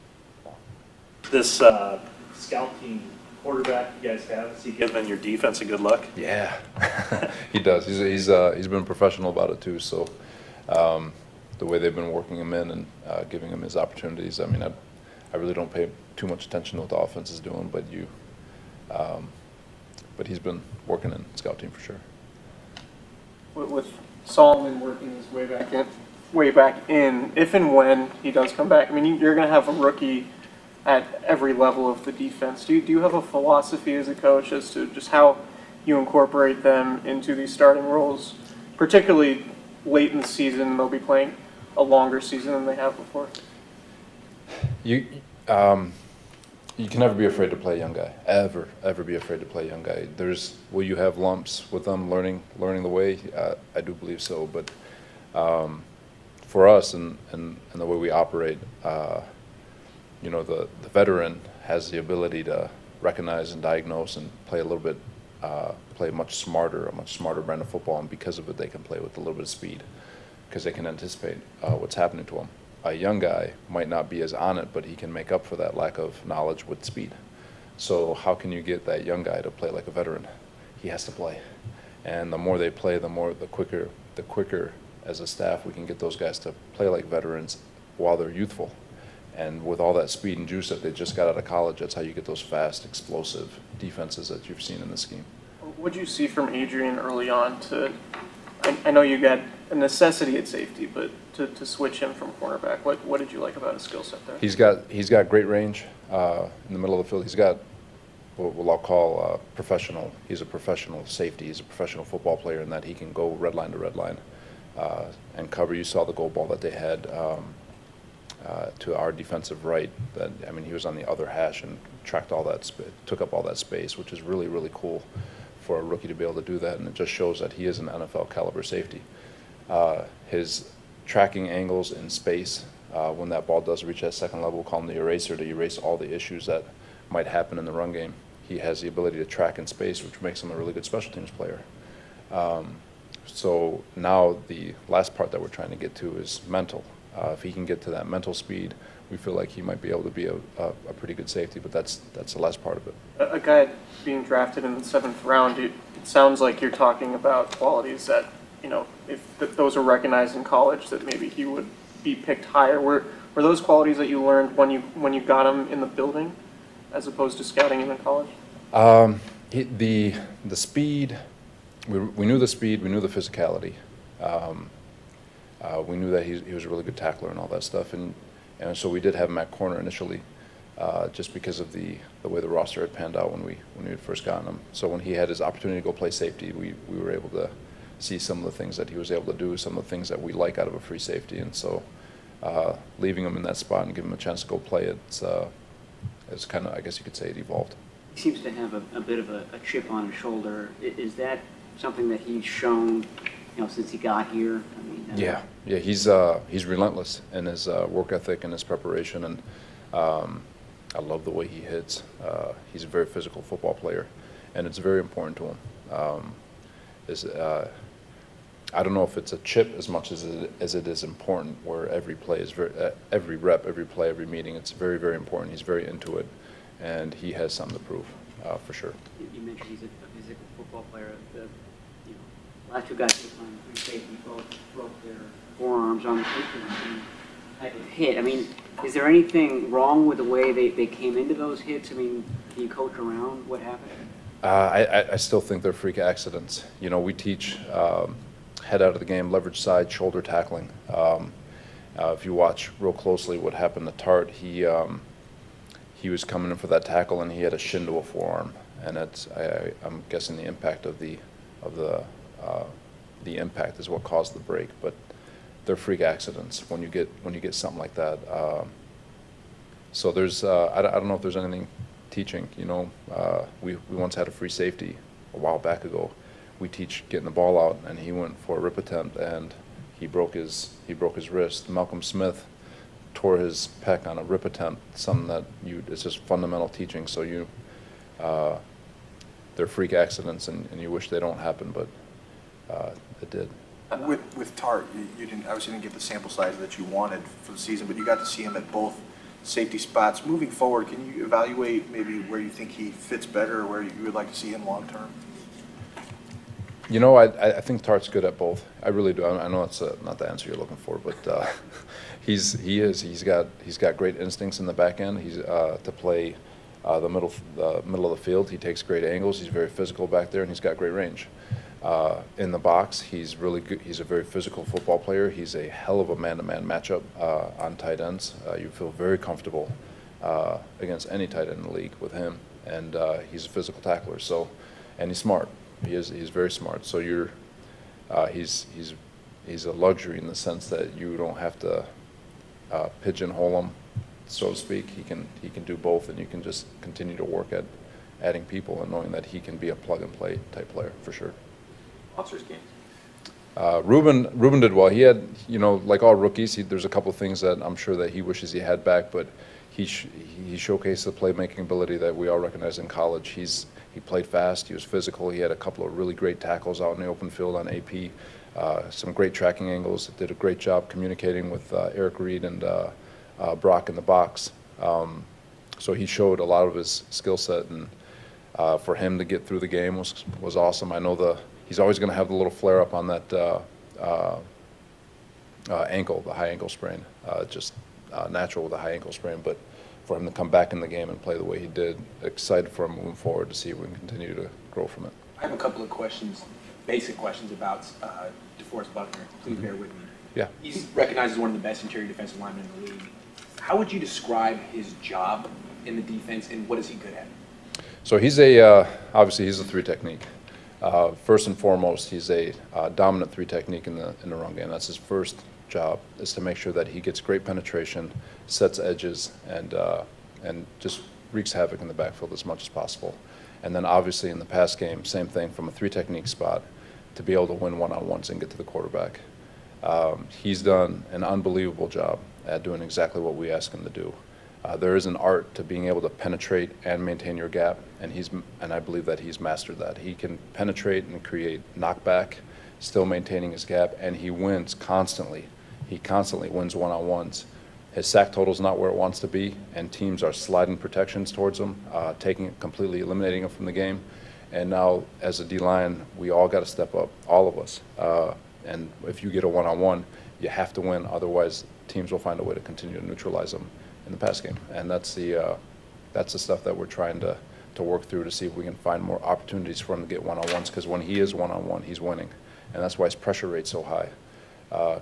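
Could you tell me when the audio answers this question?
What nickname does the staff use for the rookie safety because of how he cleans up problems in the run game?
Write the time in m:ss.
2:14.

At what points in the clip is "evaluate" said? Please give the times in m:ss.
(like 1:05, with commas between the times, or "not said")
5:01.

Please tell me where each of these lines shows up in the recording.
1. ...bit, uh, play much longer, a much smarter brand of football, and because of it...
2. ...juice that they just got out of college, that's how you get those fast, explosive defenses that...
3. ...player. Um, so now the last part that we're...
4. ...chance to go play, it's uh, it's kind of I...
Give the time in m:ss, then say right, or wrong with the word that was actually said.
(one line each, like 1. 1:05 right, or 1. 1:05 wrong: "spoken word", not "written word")
1. 1:04 wrong: "smarter", not "longer"
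2. 1:30 right
3. 2:21 right
4. 3:14 right.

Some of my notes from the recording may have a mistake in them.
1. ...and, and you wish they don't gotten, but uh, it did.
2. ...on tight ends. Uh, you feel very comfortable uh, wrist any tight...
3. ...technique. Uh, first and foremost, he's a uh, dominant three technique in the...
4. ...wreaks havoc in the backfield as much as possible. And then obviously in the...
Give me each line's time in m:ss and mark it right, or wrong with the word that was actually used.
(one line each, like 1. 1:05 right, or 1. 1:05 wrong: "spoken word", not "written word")
1. 4:50 wrong: "happen", not "gotten"
2. 5:27 wrong: "against", not "wrist"
3. 6:49 right
4. 7:01 right.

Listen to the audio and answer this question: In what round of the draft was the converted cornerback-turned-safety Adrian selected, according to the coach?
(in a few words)
seventh round.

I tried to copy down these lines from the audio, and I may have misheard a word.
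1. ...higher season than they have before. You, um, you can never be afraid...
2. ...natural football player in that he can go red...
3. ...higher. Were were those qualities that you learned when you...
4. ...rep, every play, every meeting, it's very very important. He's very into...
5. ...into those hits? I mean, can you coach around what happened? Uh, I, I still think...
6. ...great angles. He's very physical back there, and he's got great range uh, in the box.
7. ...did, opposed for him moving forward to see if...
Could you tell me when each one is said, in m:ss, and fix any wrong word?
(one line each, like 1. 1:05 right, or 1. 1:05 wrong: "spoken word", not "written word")
1. 0:41 wrong: "longer", not "higher"
2. 1:51 wrong: "professional", not "natural"
3. 2:42 right
4. 3:43 right
5. 4:01 right
6. 5:18 right
7. 6:31 wrong: "excited", not "opposed".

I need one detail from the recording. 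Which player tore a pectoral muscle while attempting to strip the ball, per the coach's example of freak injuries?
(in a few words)
Malcolm Smith.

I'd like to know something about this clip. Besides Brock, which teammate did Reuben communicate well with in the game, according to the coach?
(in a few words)
Eric Reid.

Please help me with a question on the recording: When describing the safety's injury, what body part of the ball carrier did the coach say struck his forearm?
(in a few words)
shin.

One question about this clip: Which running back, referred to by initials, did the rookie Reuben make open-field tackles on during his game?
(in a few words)
AP.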